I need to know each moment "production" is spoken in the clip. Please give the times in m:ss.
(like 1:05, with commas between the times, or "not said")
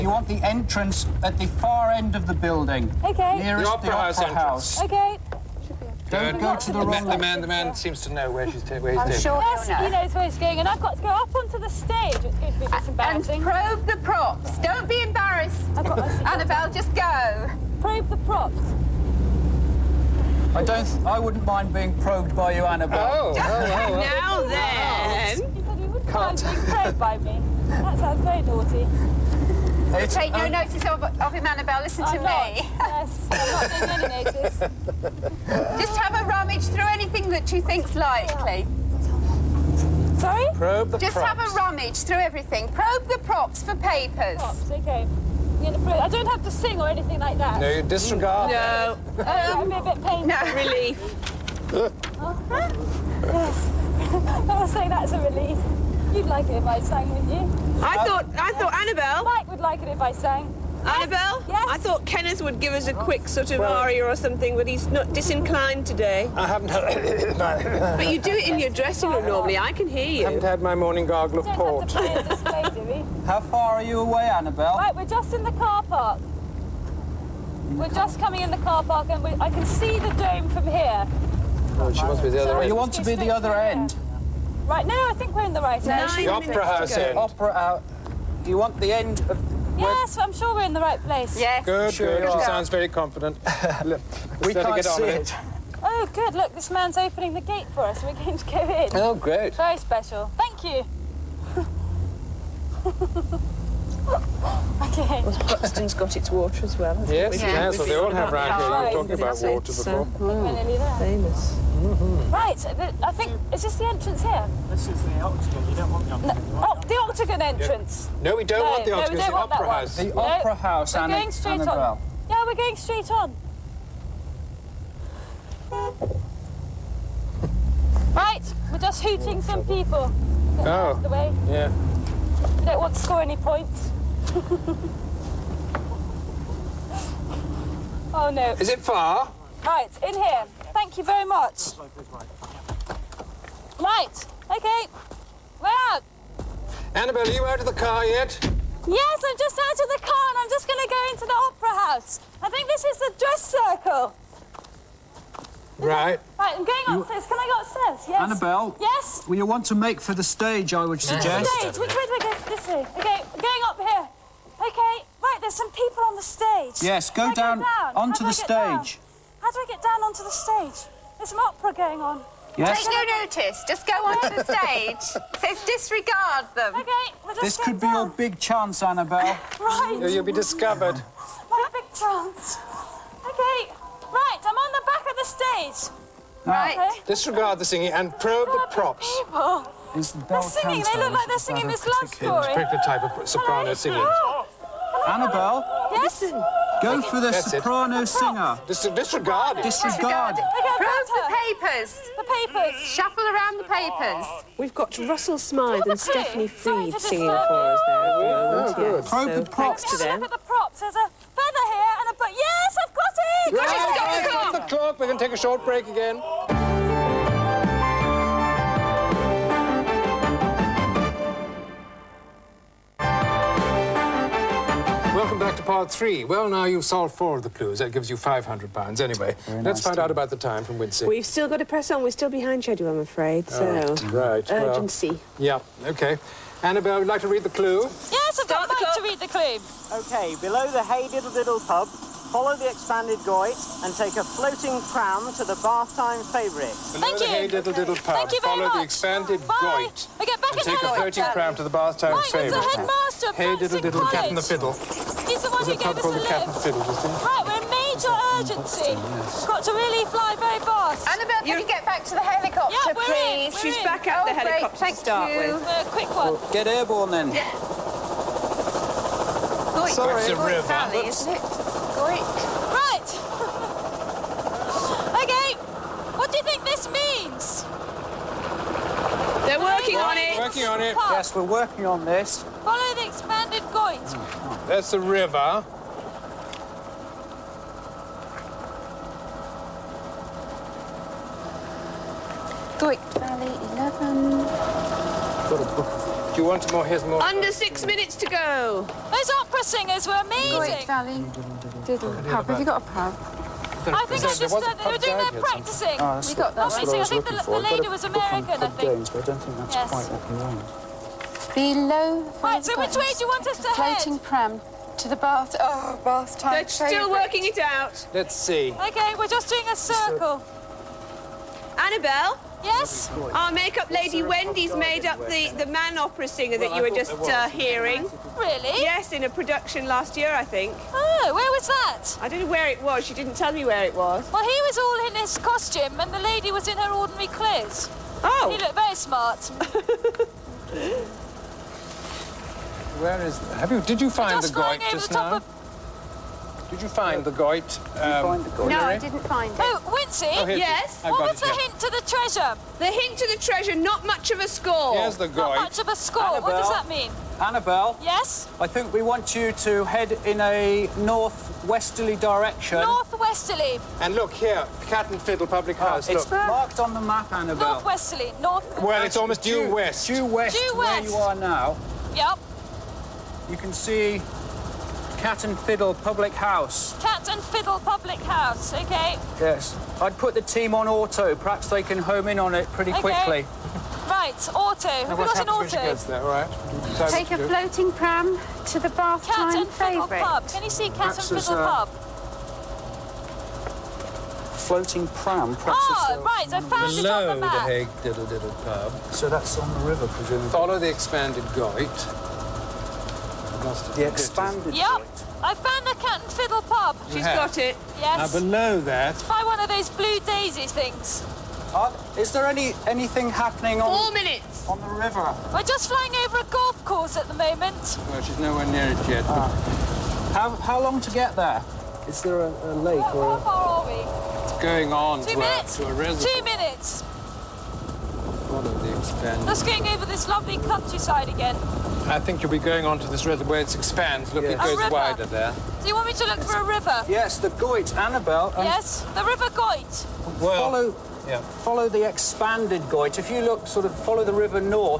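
5:29.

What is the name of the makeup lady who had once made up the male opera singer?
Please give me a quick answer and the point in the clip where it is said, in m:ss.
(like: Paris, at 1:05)
Wendy, at 5:24.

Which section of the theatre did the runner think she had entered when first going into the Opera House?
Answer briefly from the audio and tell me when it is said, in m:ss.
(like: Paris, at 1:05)
the dress circle, at 2:32.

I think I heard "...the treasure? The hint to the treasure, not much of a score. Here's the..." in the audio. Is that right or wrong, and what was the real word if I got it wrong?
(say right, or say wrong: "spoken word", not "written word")
right.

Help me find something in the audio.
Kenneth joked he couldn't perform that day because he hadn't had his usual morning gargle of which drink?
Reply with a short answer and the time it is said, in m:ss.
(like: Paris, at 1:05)
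port, at 1:11.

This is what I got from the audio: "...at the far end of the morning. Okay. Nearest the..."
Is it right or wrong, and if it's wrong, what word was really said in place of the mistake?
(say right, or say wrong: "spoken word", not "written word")
wrong: "building", not "morning".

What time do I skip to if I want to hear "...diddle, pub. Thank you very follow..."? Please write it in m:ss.
4:07.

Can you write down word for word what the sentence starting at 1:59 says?
The no, opera house we're and, going straight on.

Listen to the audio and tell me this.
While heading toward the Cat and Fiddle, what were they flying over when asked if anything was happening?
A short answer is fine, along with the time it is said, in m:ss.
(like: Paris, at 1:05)
a golf course, at 6:56.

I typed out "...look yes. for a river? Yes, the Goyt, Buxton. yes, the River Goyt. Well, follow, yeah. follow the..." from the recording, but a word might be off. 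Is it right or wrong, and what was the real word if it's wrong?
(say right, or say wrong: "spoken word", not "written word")
wrong: "Annabel", not "Buxton".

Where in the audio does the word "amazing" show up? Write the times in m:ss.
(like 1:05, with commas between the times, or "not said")
5:00.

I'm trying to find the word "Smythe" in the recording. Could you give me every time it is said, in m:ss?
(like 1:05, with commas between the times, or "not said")
3:25.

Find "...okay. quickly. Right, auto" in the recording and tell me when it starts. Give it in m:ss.
6:22.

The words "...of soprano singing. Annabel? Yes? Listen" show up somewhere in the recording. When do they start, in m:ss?
3:13.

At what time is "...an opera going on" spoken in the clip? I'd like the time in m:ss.
2:51.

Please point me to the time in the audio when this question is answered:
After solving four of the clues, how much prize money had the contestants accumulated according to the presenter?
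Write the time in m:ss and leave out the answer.
3:48.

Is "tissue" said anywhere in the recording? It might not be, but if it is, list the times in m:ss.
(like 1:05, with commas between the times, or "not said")
not said.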